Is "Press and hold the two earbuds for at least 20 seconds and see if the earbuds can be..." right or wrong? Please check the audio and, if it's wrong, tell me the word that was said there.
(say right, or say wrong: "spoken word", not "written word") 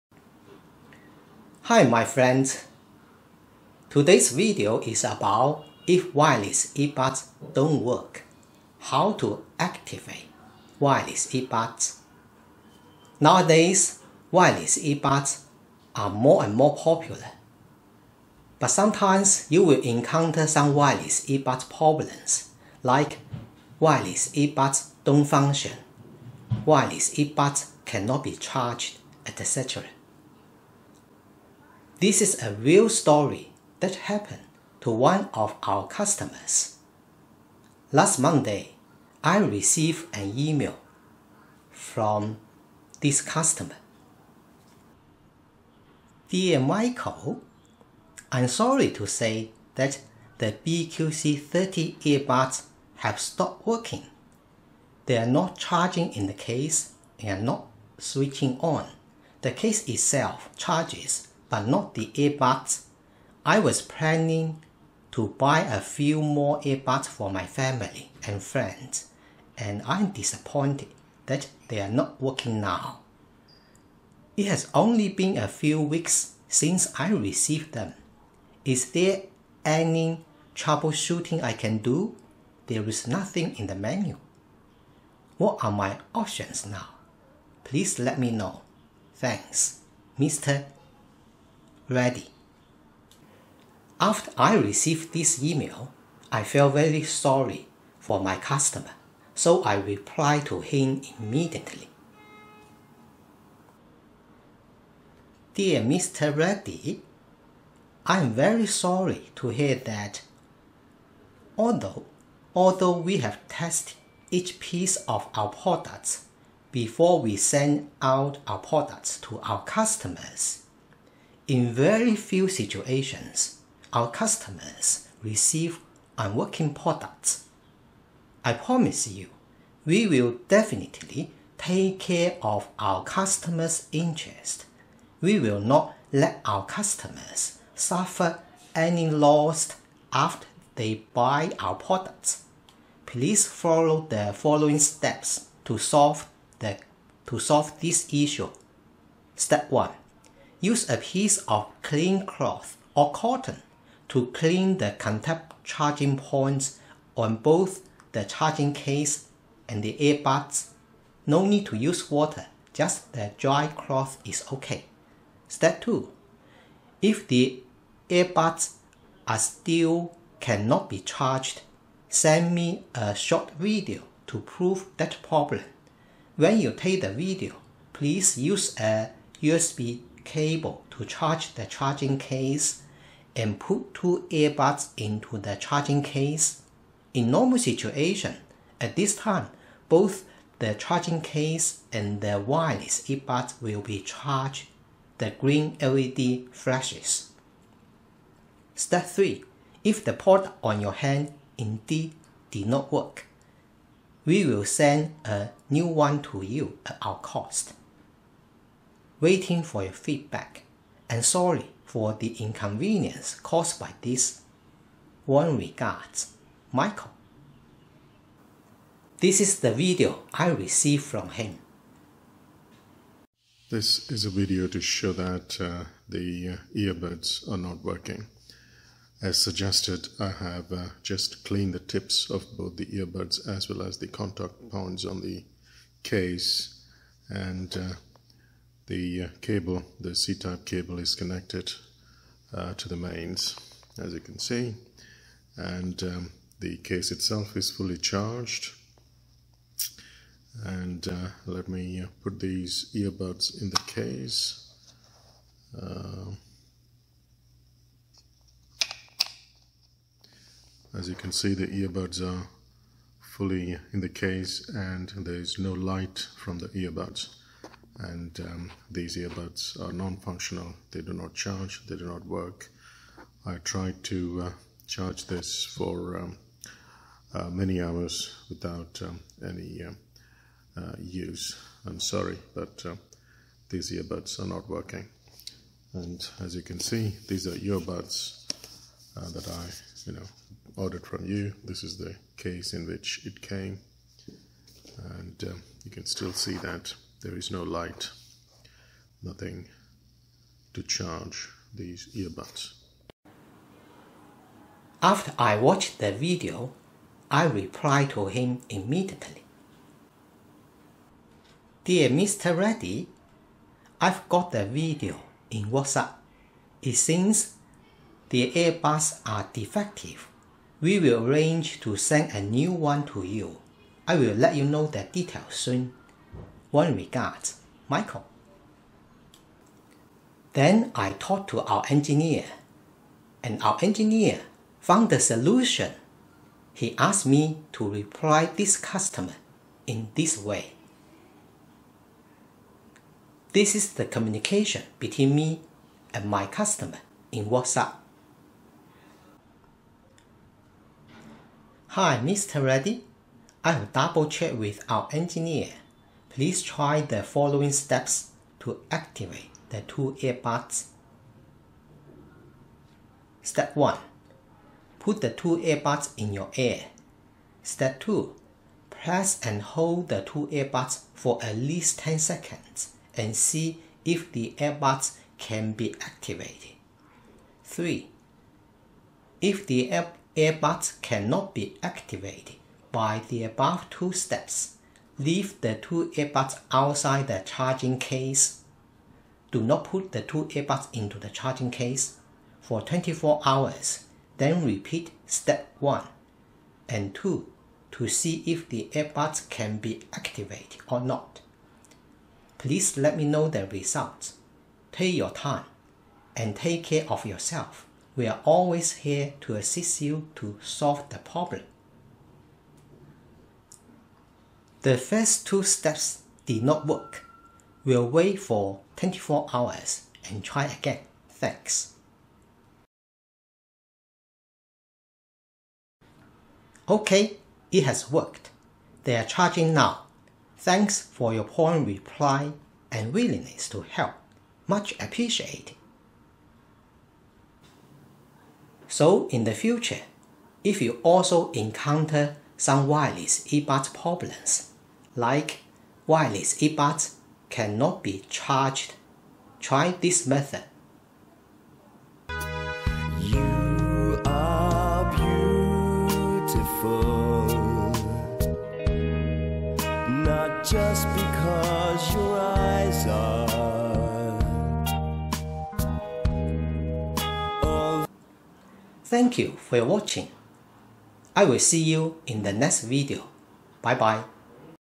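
wrong: "10", not "20".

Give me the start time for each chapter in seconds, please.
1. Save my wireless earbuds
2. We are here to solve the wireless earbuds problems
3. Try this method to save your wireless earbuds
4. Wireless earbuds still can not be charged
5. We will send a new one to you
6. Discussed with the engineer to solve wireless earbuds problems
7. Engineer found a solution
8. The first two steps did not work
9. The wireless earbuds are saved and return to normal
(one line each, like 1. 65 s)
1. 45 s
2. 93 s
3. 103 s
4. 218 s
5. 303 s
6. 329 s
7. 349 s
8. 413 s
9. 425 s.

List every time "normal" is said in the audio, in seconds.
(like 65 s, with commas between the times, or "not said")
187 s.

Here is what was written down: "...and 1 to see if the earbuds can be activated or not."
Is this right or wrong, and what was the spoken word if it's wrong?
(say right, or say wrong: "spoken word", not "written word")
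wrong: "2", not "1".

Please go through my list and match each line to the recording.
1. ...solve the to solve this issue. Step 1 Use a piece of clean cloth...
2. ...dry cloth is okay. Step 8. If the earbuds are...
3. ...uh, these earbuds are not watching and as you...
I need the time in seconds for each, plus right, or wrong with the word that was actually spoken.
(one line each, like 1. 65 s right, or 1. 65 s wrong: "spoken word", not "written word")
1. 145 s right
2. 163 s wrong: "2", not "8"
3. 282 s wrong: "working", not "watching".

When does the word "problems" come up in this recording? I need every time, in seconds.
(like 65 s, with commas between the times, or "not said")
21 s, 175 s, 411 s, 443 s.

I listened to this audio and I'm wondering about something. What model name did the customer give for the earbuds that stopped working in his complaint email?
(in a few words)
BQC30.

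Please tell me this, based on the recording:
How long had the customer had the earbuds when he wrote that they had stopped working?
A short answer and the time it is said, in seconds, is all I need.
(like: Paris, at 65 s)
A few weeks, at 75 s.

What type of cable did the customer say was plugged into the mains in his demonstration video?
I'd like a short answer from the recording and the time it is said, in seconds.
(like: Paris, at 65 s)
C-type cable, at 240 s.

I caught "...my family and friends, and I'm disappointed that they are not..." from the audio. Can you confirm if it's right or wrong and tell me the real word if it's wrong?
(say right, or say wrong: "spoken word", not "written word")
right.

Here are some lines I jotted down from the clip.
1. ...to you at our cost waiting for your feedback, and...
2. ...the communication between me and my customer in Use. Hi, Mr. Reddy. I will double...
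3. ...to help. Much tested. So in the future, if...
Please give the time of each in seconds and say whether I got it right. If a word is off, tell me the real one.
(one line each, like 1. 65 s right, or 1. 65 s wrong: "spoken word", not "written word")
1. 206 s right
2. 343 s wrong: "WhatsApp", not "Use"
3. 433 s wrong: "appreciated", not "tested".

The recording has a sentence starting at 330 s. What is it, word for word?
Then I talked to our engineer, and our engineer found the solution.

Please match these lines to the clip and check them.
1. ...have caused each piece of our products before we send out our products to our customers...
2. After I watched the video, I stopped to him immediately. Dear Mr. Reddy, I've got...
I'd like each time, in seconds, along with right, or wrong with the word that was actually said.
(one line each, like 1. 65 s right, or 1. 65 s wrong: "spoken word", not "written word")
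1. 113 s wrong: "tested", not "caused"
2. 305 s wrong: "replied", not "stopped".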